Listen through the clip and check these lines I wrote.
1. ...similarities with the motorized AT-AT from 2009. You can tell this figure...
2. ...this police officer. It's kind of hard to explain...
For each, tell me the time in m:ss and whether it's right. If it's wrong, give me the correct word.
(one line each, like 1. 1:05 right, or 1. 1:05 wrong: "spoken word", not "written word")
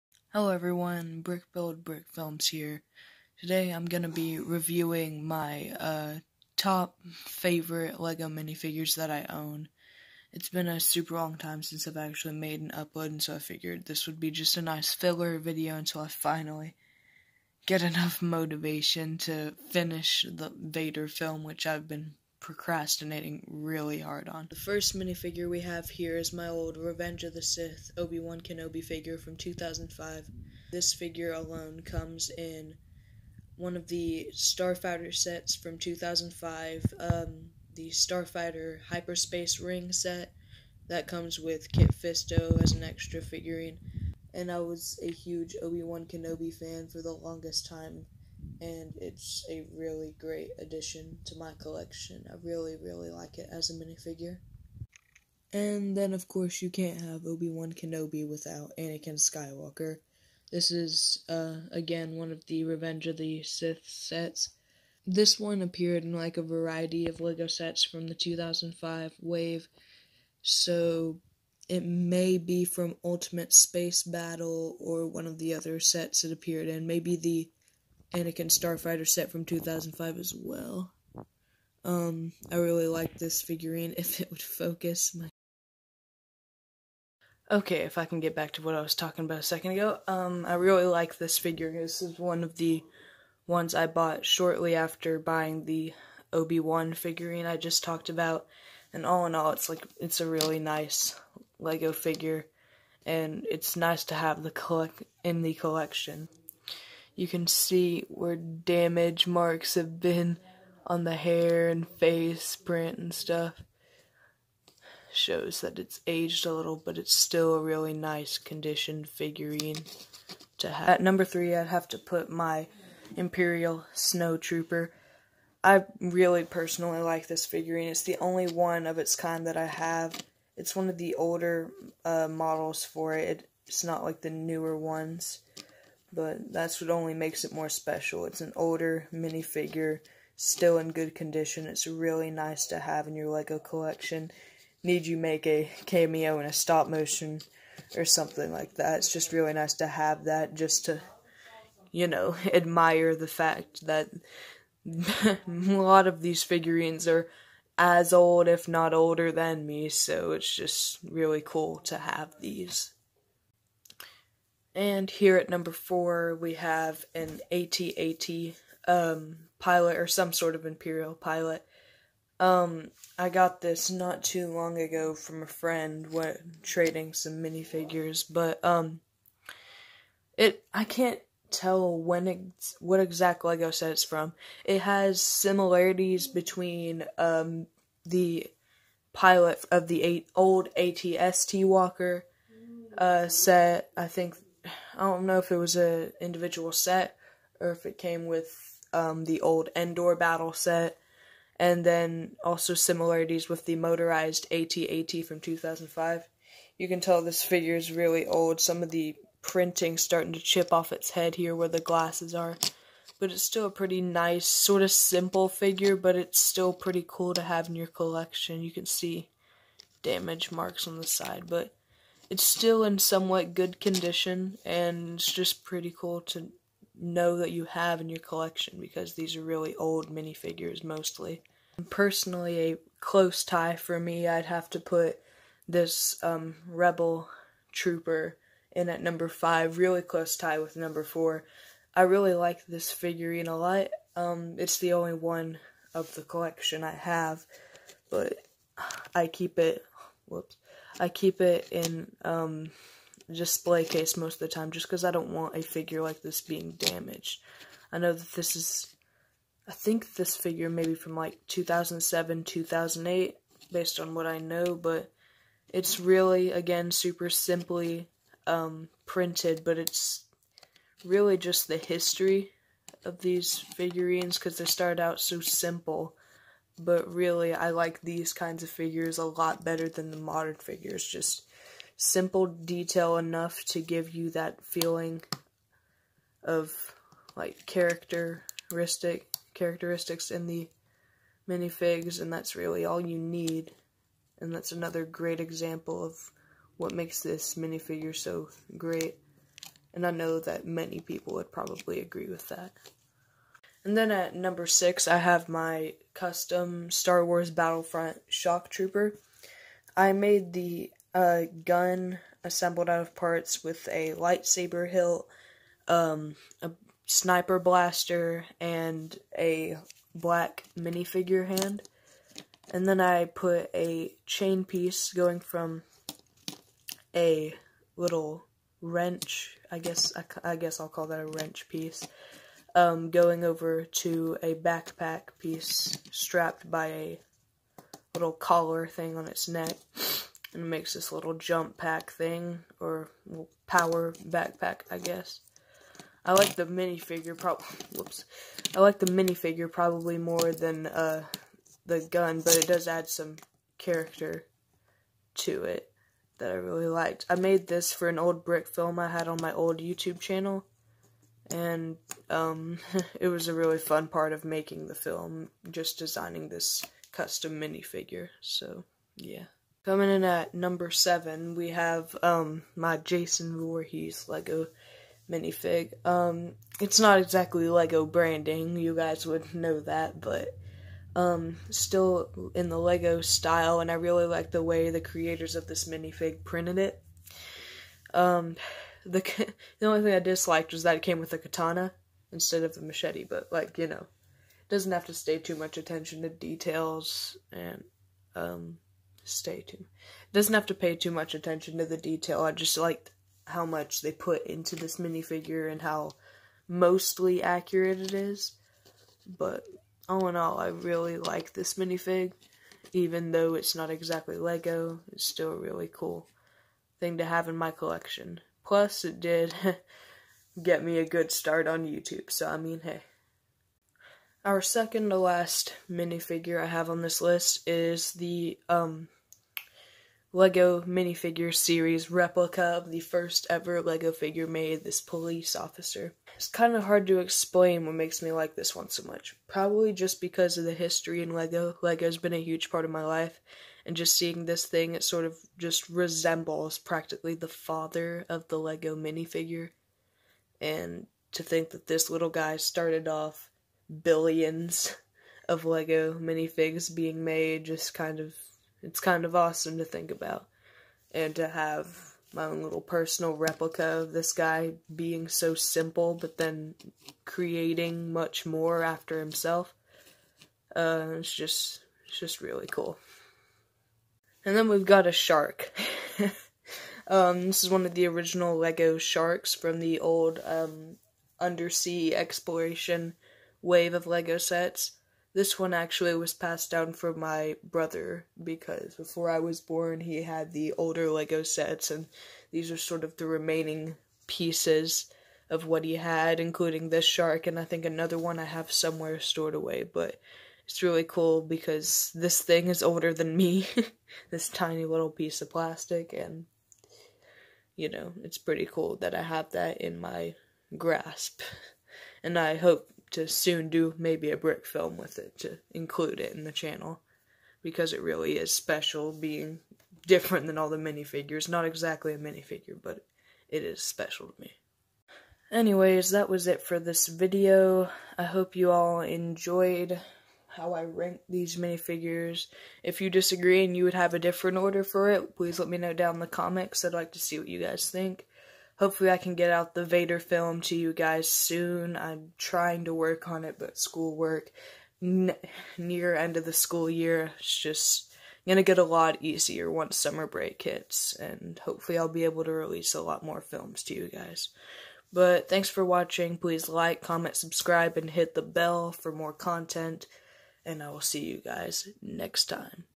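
1. 3:22 wrong: "2005", not "2009"
2. 7:14 right.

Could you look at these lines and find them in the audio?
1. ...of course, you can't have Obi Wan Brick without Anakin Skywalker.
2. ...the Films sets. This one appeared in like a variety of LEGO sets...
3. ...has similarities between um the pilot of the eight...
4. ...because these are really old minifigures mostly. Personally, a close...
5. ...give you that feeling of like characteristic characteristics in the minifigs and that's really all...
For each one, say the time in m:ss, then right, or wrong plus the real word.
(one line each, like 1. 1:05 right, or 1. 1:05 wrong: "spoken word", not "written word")
1. 0:56 wrong: "Kenobi", not "Brick"
2. 1:03 wrong: "Sith", not "Films"
3. 3:04 right
4. 3:48 right
5. 4:43 right.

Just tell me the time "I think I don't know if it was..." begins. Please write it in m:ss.
3:13.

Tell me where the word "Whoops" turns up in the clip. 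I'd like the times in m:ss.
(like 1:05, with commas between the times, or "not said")
4:10, 5:47.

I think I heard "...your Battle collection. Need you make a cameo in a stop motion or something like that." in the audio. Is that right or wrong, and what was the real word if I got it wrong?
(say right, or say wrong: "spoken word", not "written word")
wrong: "LEGO", not "Battle".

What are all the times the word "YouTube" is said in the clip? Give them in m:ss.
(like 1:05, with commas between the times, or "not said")
5:59, 7:01.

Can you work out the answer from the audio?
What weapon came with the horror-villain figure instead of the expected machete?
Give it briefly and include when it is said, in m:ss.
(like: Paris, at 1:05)
A katana, at 6:31.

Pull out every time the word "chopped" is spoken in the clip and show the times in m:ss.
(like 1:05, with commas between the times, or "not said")
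not said.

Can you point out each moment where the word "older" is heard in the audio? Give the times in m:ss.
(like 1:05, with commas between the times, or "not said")
2:11, 2:18, 2:38, 8:10, 8:22.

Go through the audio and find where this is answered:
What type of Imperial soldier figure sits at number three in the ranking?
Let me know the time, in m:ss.
2:03.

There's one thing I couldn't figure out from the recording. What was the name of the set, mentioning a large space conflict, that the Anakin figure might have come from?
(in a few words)
Ultimate Space Battle.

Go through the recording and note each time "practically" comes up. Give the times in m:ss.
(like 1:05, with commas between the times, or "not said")
7:26.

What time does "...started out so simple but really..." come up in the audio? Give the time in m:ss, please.
4:34.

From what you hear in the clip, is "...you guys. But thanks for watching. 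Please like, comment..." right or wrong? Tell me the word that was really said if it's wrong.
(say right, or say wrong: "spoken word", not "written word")
right.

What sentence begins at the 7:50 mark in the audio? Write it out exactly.
Uh, it's just it's just really cool.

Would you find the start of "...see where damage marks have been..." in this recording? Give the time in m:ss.
1:47.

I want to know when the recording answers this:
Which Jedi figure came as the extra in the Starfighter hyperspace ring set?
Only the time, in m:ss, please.
0:41.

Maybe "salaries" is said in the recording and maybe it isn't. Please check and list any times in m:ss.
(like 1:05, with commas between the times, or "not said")
not said.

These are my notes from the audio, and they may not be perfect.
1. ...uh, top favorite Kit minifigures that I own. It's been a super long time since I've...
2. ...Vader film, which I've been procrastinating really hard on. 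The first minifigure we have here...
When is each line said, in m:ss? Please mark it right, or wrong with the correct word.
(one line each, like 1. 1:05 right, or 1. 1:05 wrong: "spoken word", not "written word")
1. 0:05 wrong: "LEGO", not "Kit"
2. 0:20 right.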